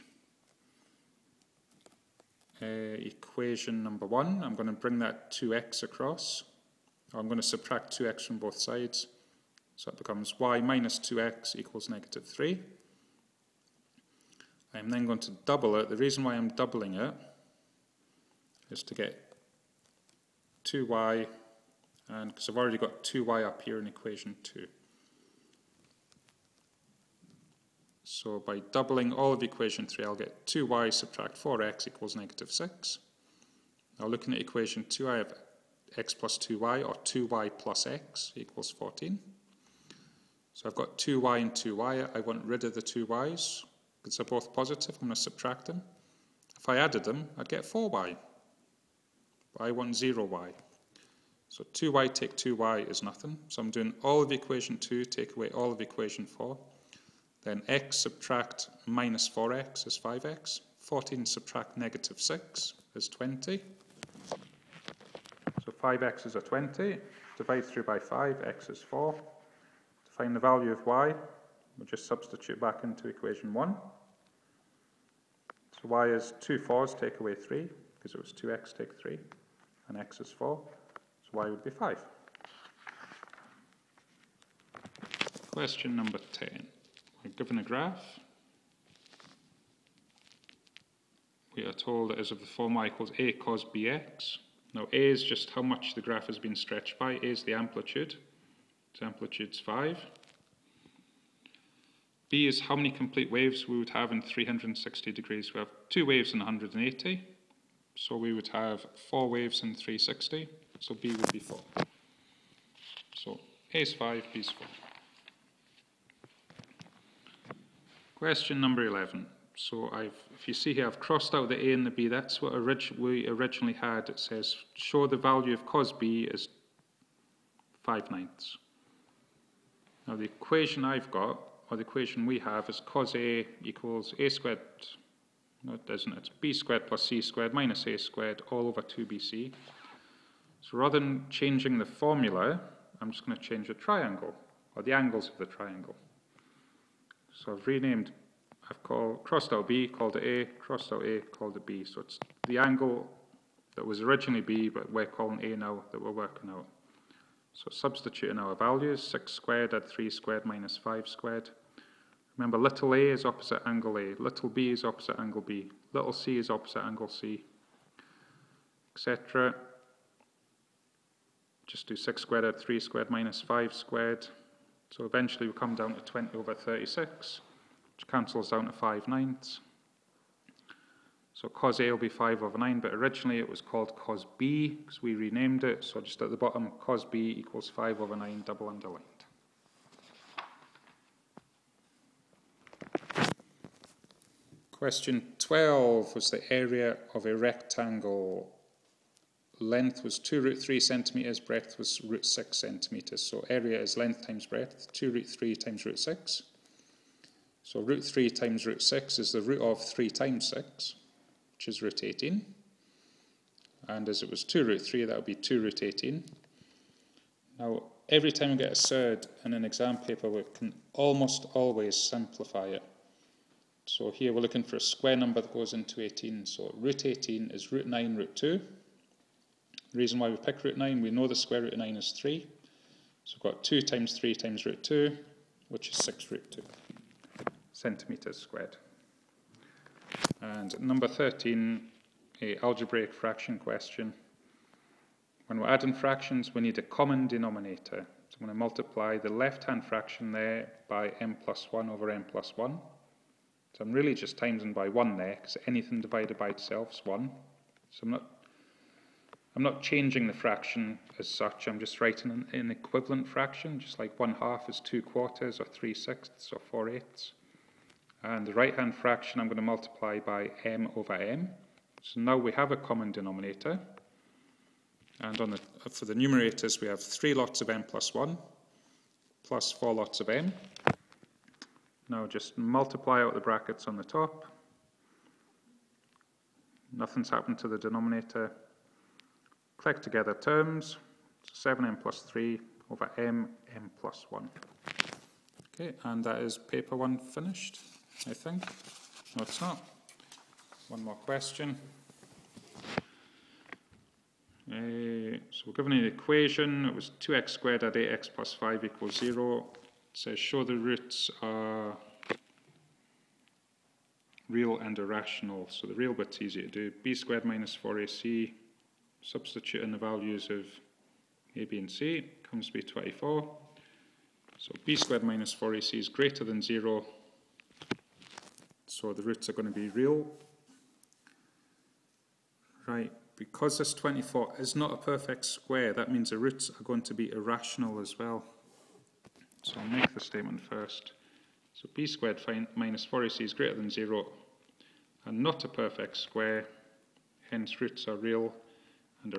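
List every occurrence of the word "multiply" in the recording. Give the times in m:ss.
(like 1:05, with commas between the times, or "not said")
4:08, 4:29, 4:42.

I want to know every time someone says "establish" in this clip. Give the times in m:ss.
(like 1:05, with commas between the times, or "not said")
not said.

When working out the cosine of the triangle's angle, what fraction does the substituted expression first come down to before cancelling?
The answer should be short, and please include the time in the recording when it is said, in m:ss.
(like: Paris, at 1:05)
20/36, at 2:56.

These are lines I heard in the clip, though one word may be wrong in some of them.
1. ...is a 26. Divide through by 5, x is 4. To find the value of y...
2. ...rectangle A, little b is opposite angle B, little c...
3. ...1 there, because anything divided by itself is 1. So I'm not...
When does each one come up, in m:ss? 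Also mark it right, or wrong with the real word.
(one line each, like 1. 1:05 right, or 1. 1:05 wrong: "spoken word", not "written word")
1. 1:06 wrong: "20", not "26"
2. 2:43 wrong: "angle", not "rectangle"
3. 4:14 right.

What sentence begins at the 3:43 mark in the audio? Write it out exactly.
So here we're looking for a square number that goes into 18.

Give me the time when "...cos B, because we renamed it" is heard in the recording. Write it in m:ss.
3:03.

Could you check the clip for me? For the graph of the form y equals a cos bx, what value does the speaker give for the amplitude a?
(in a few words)
5.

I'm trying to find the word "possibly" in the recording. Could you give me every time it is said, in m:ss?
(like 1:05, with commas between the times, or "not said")
not said.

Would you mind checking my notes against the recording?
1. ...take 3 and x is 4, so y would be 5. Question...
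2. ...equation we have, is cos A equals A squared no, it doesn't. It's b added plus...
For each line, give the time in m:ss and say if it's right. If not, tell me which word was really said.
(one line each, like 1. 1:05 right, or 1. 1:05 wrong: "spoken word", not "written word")
1. 1:18 right
2. 2:11 wrong: "squared", not "added".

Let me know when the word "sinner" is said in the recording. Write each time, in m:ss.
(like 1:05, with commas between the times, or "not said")
not said.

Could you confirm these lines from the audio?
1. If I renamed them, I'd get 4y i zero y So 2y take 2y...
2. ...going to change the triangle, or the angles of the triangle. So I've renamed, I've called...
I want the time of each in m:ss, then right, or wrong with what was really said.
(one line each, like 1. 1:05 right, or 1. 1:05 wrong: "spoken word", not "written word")
1. 0:46 wrong: "added", not "renamed"
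2. 2:23 right.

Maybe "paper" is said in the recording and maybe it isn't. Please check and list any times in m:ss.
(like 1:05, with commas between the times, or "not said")
3:39, 4:56.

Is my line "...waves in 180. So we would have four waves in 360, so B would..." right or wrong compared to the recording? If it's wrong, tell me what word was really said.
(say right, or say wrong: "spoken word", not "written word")
right.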